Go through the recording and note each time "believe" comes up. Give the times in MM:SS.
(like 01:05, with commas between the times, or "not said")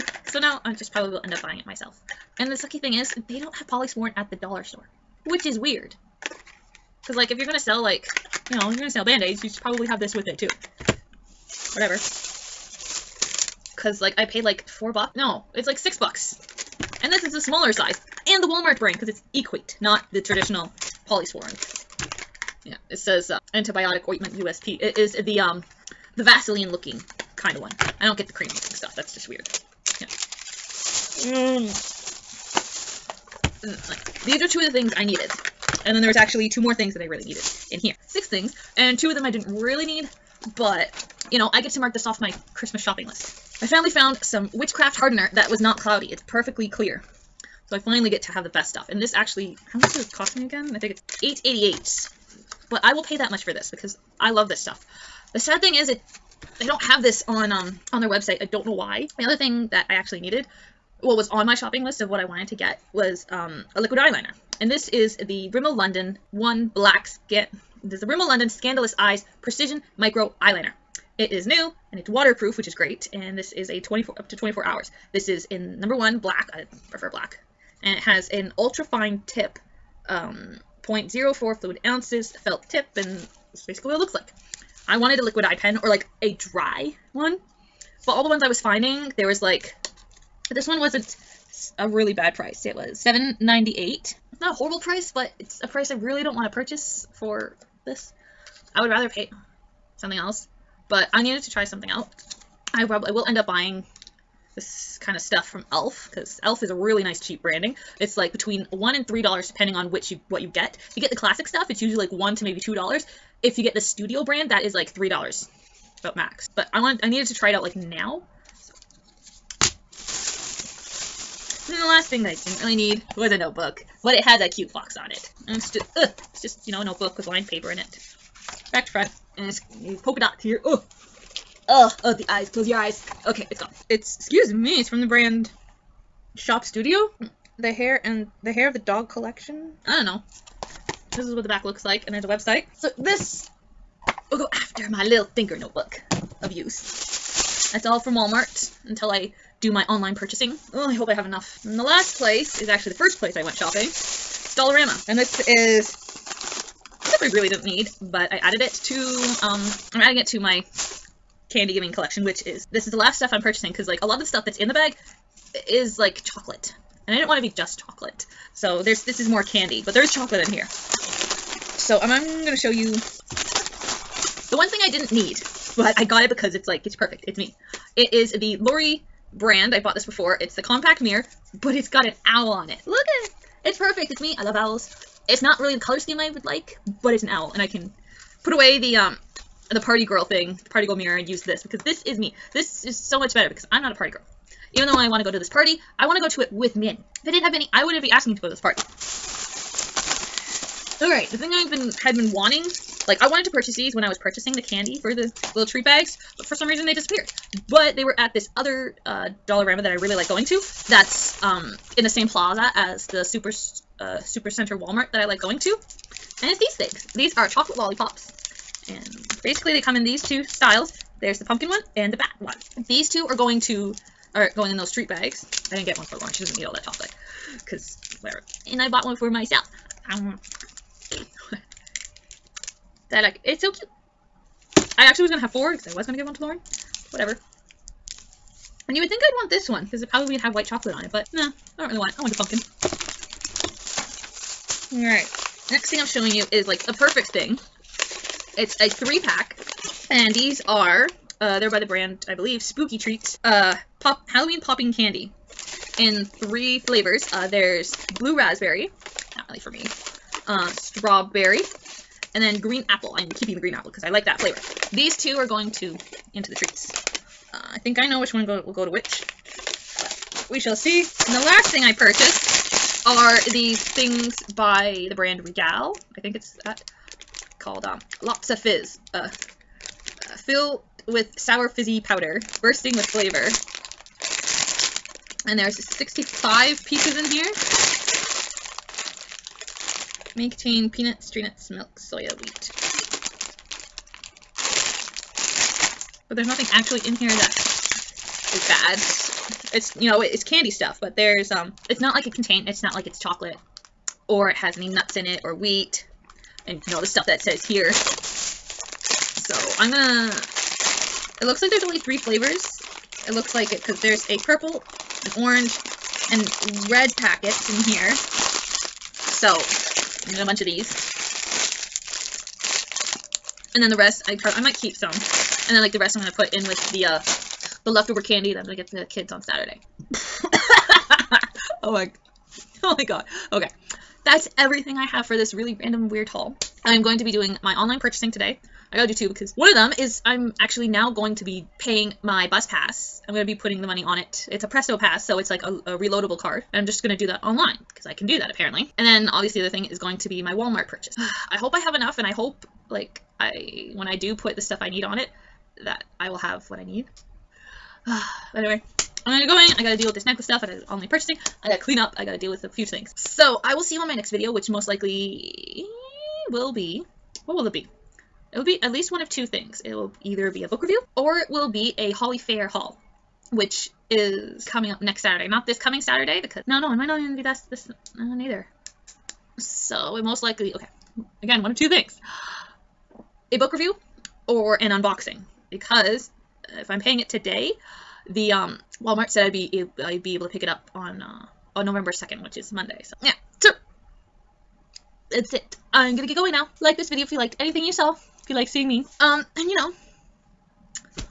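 04:12.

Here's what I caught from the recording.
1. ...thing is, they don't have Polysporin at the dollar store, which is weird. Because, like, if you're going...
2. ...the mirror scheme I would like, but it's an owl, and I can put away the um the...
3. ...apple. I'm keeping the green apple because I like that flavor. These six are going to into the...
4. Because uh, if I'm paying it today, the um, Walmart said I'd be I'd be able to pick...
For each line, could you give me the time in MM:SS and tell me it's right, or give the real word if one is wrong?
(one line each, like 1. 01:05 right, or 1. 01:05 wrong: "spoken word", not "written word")
1. 00:02 right
2. 03:05 wrong: "color", not "mirror"
3. 04:22 wrong: "two", not "six"
4. 06:25 right.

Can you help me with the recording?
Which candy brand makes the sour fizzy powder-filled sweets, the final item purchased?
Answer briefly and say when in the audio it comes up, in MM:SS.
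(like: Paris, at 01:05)
Regal, at 04:35.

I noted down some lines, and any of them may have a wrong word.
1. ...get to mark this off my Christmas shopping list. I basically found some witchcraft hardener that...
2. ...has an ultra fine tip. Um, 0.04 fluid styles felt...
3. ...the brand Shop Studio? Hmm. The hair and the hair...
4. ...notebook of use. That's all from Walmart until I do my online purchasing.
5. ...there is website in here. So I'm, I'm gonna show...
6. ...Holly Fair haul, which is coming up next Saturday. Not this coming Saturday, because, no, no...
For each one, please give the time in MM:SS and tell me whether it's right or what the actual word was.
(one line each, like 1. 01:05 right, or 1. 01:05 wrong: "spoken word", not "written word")
1. 00:41 wrong: "finally", not "basically"
2. 01:18 wrong: "ounces", not "styles"
3. 02:15 right
4. 02:25 right
5. 02:49 wrong: "chocolate", not "website"
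6. 06:12 right.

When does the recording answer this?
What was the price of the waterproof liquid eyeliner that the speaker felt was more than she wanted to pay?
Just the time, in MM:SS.
01:32.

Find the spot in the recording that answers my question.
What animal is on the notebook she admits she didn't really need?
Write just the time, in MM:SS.
02:04.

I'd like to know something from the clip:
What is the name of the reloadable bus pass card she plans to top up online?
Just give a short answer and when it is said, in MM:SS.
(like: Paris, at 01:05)
Presto Pass, at 05:44.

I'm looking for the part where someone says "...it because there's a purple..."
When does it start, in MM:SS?
05:13.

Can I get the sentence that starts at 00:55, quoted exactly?
The sad thing is it they don't have this on um, on their website.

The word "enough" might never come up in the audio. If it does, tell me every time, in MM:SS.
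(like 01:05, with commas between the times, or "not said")
02:31, 05:51.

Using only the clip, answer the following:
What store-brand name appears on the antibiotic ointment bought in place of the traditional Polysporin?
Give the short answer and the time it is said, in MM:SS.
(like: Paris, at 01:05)
Equate, at 00:19.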